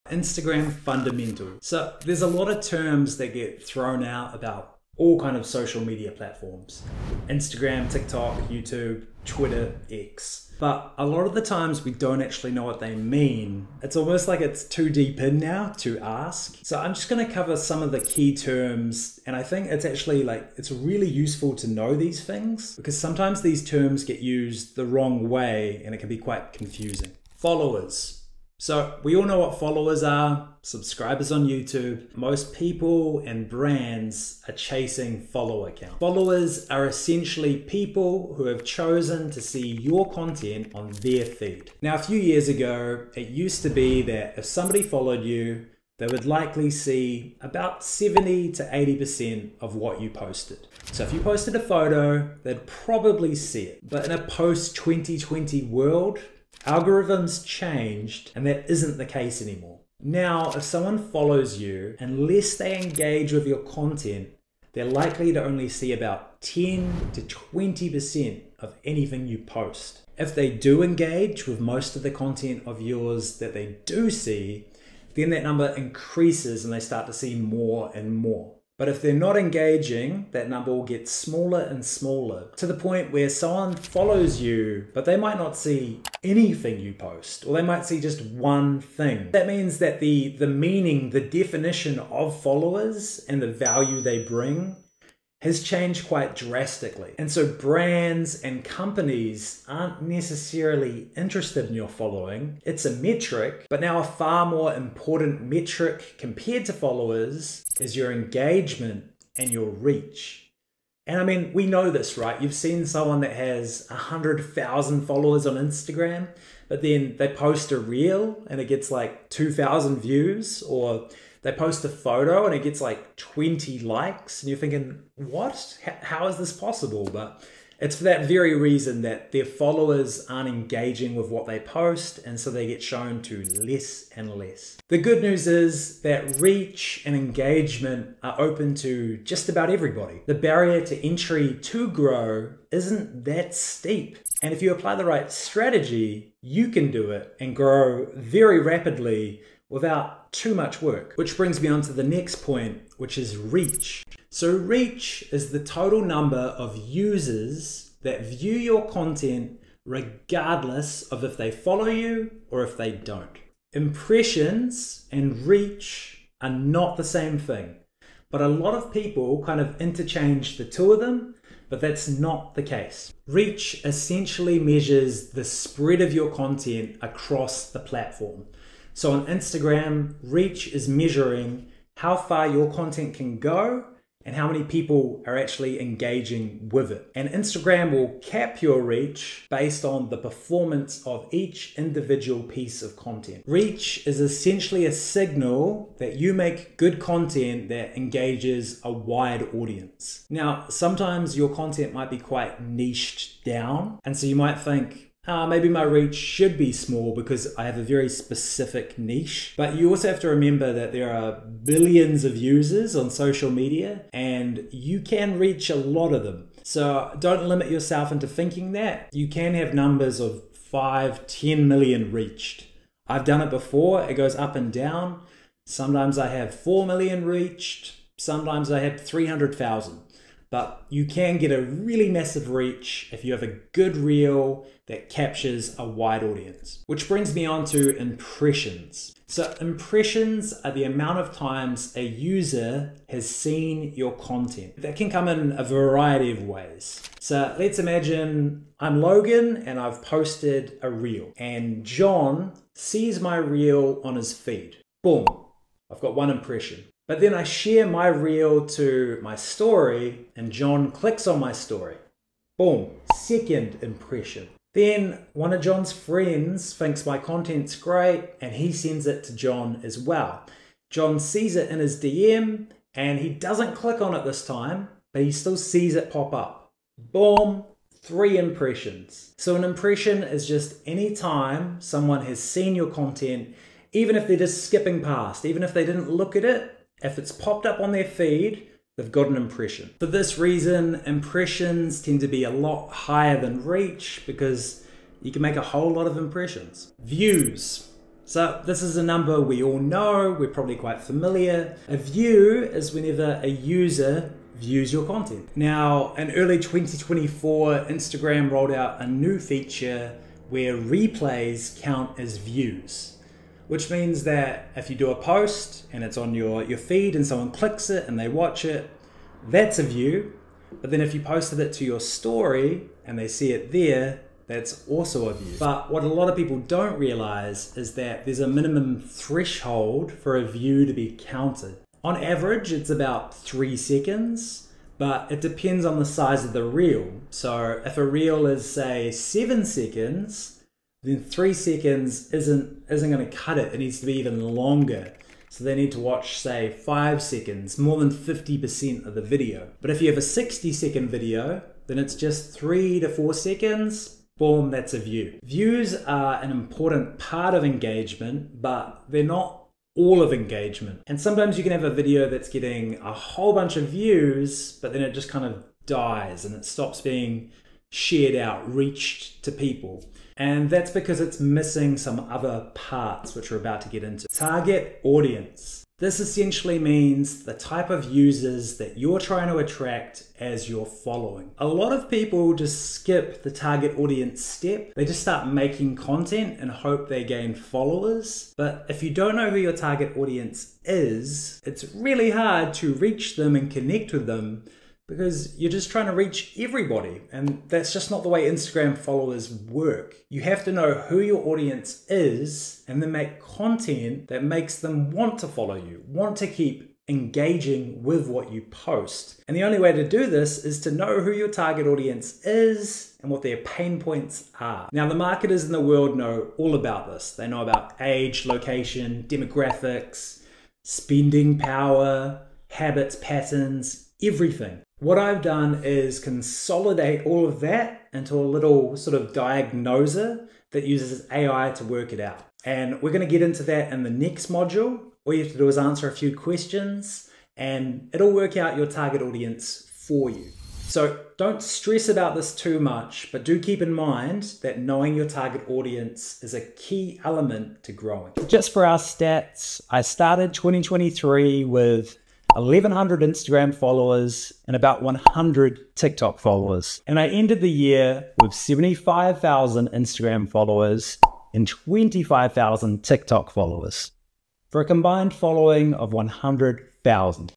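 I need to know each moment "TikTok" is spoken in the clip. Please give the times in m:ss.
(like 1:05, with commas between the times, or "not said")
0:07, 7:35, 7:43.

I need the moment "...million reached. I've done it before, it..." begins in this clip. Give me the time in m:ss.
3:41.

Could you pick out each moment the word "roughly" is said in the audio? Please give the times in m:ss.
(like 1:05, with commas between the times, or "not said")
not said.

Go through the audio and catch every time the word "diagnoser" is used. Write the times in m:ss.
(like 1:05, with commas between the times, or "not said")
7:09.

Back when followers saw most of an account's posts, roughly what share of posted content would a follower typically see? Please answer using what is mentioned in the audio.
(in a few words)
70 to 80%.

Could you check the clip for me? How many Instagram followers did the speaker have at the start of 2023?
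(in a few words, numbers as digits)
1,100.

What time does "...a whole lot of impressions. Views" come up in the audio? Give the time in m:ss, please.
4:55.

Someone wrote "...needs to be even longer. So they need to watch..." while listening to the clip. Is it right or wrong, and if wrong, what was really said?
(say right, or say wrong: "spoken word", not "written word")
right.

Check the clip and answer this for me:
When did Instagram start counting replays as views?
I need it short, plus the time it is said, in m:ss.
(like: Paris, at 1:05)
early 2024, at 5:06.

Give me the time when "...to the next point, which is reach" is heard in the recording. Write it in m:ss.
2:31.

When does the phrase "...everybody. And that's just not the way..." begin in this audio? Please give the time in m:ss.
6:36.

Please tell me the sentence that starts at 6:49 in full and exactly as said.
And the only way to do this is to know who your target audience is and what their pain points are.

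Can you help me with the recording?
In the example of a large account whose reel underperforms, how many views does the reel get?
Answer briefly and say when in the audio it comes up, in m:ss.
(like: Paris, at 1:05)
2,000, at 1:59.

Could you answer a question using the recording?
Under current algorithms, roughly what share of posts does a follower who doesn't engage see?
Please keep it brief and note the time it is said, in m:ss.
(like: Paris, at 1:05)
10 to 20%, at 1:06.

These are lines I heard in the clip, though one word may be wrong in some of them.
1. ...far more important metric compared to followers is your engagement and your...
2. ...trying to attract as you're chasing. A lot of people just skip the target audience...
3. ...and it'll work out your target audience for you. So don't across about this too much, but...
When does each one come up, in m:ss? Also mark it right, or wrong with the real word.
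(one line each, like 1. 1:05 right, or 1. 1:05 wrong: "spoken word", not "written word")
1. 1:44 right
2. 6:19 wrong: "following", not "chasing"
3. 7:17 wrong: "stress", not "across".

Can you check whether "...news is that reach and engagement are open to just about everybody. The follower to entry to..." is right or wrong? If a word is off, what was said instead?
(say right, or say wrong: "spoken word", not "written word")
wrong: "barrier", not "follower".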